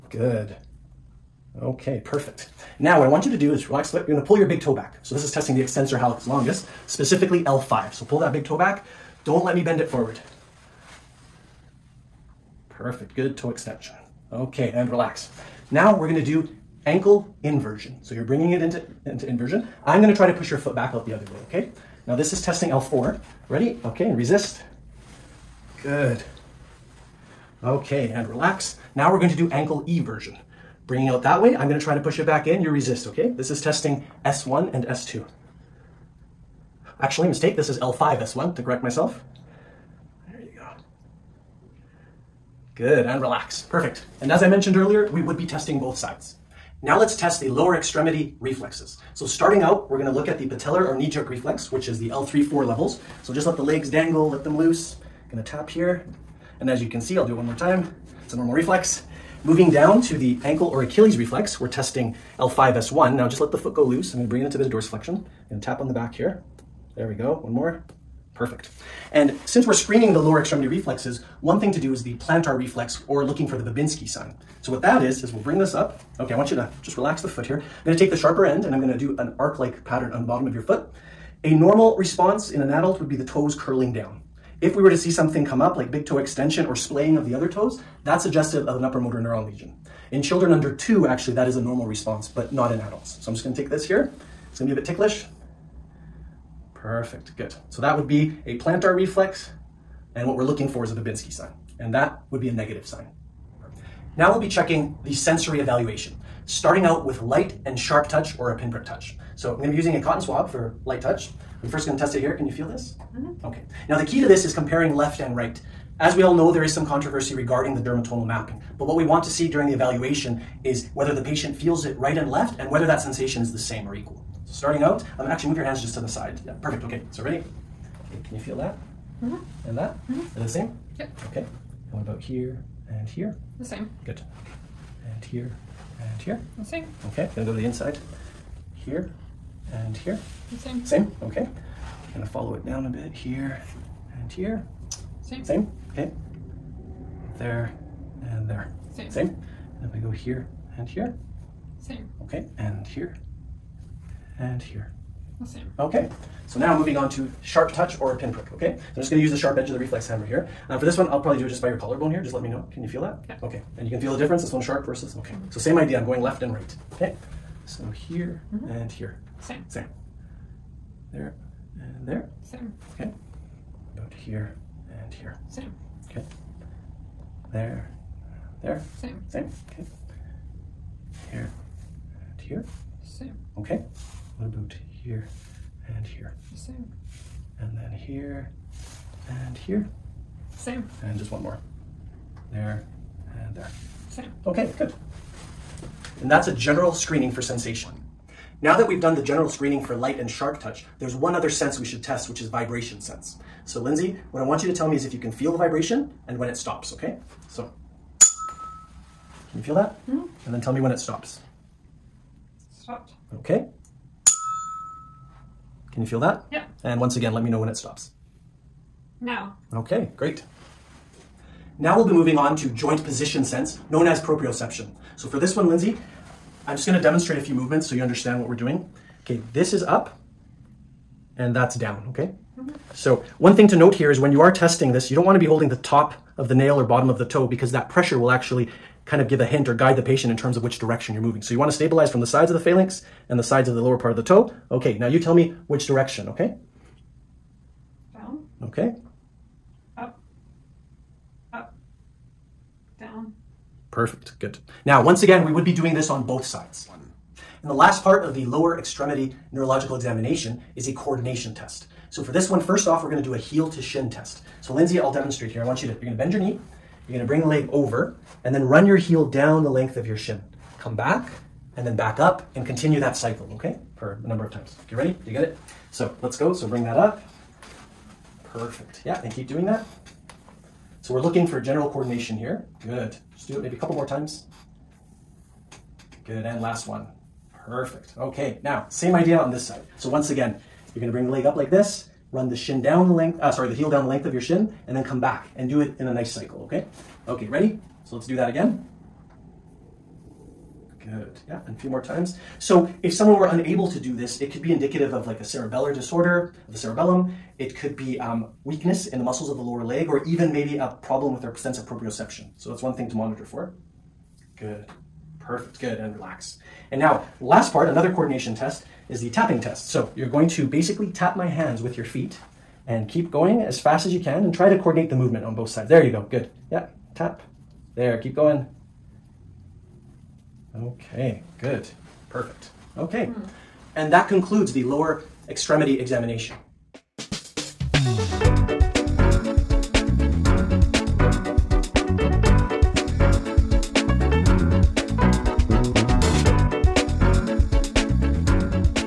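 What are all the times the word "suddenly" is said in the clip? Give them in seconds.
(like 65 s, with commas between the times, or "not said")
not said.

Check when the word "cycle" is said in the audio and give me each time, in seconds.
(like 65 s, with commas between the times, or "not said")
273 s, 296 s.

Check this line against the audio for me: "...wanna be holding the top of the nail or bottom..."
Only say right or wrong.
right.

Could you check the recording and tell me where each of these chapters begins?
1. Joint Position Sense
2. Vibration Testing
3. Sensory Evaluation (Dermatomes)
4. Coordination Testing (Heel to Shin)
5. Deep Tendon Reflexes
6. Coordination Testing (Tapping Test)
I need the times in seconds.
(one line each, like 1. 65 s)
1. 221 s
2. 198 s
3. 103 s
4. 257 s
5. 46 s
6. 317 s.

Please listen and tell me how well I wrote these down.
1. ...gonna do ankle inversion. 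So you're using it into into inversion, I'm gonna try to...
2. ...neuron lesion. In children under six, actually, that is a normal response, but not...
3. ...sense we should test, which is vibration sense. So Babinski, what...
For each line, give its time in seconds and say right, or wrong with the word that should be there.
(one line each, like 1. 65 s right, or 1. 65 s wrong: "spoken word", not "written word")
1. 16 s wrong: "bringing", not "using"
2. 89 s wrong: "two", not "six"
3. 201 s wrong: "Lindsay", not "Babinski".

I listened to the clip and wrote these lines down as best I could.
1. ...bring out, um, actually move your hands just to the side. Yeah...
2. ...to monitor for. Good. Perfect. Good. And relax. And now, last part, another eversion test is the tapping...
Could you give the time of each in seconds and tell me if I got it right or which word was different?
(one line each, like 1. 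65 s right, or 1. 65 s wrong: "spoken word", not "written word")
1. 124 s wrong: "starting", not "bring"
2. 313 s wrong: "coordination", not "eversion".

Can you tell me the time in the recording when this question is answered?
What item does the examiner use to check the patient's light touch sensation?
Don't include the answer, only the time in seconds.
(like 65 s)
110 s.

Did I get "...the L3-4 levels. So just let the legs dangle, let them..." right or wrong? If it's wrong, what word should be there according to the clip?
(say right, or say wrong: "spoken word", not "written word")
right.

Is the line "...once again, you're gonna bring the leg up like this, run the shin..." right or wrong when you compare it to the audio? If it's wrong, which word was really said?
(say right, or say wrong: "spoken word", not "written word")
right.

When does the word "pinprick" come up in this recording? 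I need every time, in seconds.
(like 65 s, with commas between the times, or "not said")
108 s, 158 s.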